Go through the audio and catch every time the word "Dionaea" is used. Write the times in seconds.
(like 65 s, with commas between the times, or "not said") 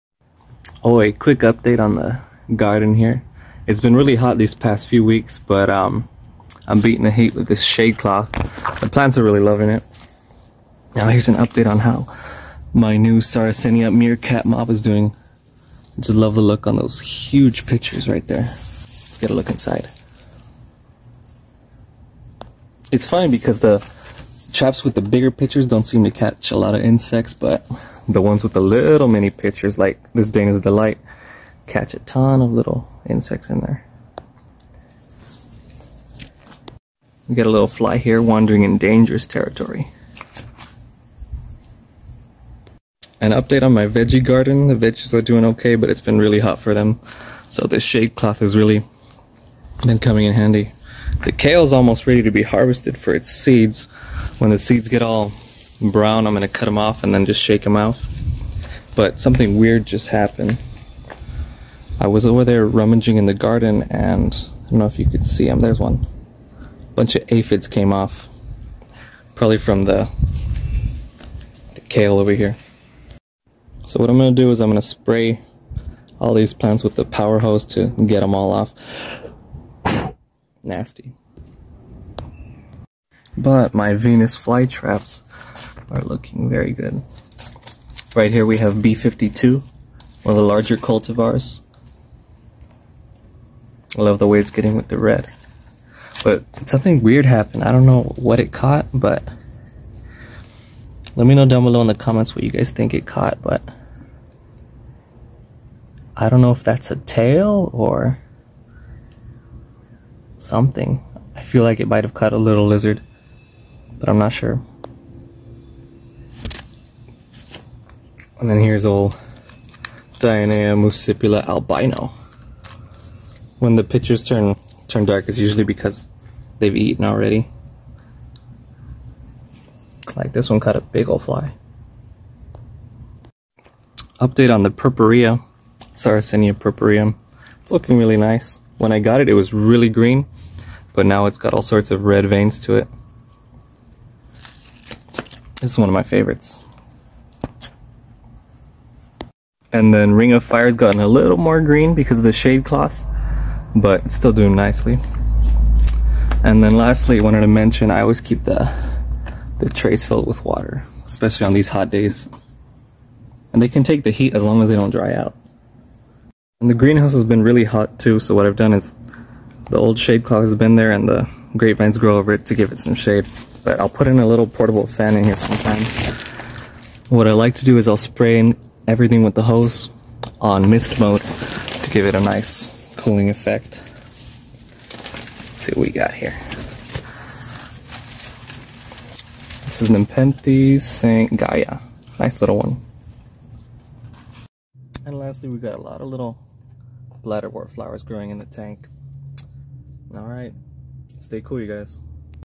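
120 s.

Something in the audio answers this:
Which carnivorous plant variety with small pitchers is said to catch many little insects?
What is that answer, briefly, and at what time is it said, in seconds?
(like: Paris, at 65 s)
Dana's Delight, at 30 s.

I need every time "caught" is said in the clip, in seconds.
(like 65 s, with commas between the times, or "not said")
98 s, 103 s, 130 s.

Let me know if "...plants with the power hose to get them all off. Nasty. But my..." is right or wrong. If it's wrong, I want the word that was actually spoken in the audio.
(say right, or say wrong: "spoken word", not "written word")
right.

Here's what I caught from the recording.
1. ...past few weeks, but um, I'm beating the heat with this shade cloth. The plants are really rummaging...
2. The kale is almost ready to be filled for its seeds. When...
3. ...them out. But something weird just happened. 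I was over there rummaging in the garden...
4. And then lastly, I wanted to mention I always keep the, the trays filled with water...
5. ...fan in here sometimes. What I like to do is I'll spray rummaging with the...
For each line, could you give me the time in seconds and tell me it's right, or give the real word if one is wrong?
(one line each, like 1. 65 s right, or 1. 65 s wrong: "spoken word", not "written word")
1. 4 s wrong: "loving", not "rummaging"
2. 51 s wrong: "harvested", not "filled"
3. 57 s right
4. 156 s right
5. 174 s wrong: "everything", not "rummaging".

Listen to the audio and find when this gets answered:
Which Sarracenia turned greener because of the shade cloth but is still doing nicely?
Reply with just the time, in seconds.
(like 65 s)
150 s.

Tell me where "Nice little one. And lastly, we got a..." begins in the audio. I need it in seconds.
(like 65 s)
192 s.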